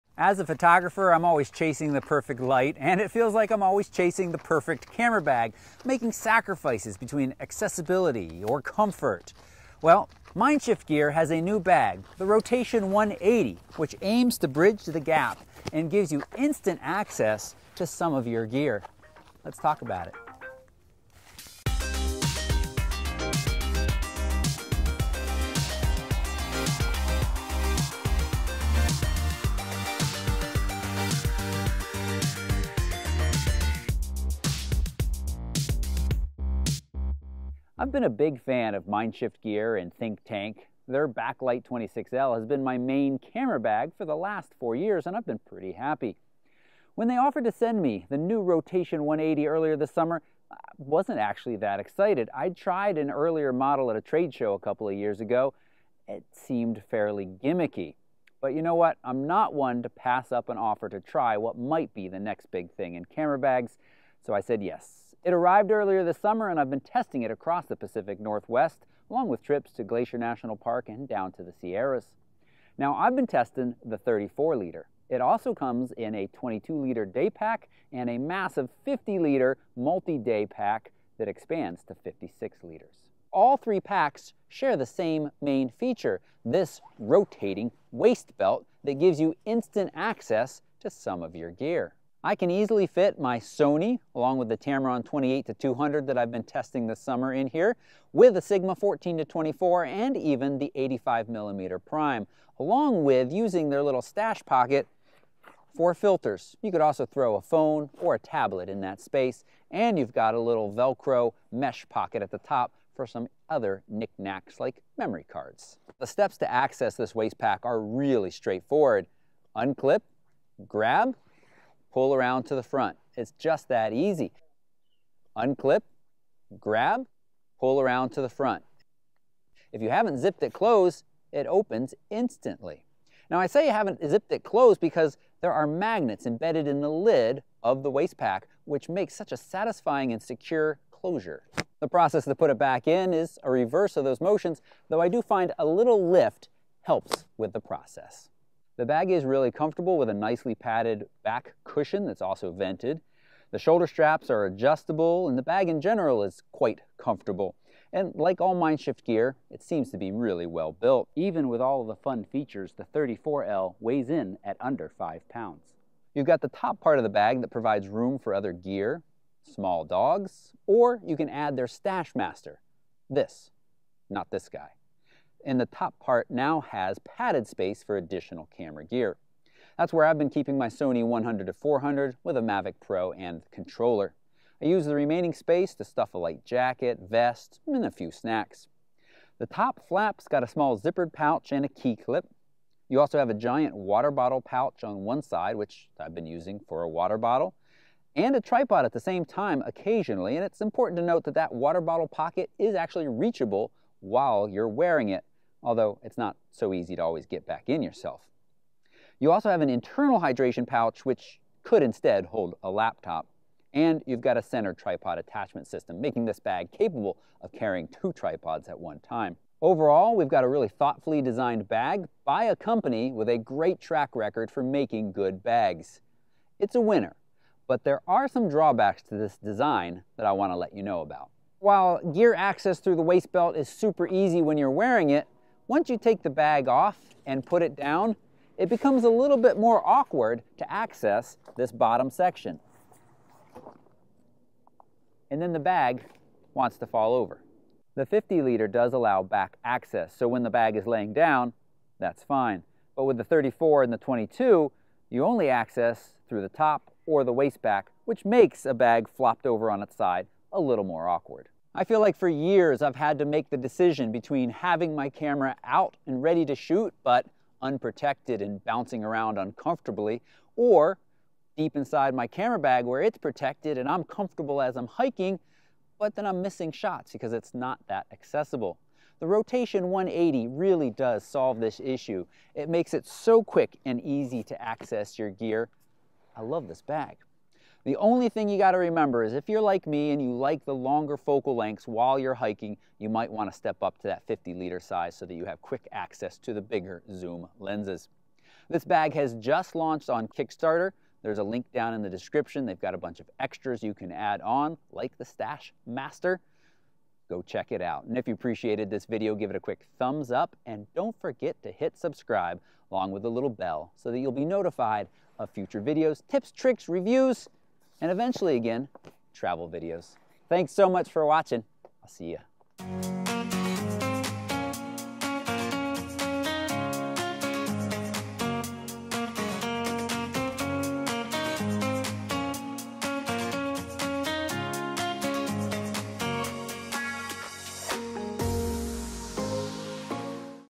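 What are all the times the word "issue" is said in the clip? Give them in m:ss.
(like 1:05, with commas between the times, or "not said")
4:41.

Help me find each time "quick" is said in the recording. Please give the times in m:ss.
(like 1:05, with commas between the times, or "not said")
4:43, 4:55, 5:09.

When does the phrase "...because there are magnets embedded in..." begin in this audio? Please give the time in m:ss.
2:14.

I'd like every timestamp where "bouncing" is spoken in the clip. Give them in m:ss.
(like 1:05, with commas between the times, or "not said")
4:28.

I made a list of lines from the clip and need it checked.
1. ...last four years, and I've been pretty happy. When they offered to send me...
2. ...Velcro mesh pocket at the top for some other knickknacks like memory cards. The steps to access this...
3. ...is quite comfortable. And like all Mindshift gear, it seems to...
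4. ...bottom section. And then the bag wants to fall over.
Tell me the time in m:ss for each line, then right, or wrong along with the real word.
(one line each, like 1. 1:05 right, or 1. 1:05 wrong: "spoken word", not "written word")
1. 0:44 right
2. 1:50 right
3. 2:36 right
4. 4:01 right.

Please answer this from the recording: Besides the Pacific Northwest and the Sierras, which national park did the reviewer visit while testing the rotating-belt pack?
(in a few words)
Glacier National Park.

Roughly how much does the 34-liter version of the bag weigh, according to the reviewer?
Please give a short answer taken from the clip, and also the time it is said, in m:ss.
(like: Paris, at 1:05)
under 5 pounds, at 2:44.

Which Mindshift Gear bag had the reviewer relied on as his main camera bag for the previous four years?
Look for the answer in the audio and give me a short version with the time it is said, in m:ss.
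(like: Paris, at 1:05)
Backlight 26L, at 0:41.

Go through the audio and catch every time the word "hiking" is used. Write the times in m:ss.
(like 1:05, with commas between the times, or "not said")
4:34, 4:52.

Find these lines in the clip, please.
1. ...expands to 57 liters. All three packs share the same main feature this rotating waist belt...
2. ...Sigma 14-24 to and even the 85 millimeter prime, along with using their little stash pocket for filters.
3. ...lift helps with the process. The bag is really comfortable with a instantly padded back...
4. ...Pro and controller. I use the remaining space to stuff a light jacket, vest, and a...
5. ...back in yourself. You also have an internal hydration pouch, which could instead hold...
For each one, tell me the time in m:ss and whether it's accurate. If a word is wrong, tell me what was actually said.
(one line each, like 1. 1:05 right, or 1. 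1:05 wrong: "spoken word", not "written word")
1. 1:21 wrong: "56", not "57"
2. 1:38 right
3. 2:26 wrong: "nicely", not "instantly"
4. 3:02 right
5. 3:27 right.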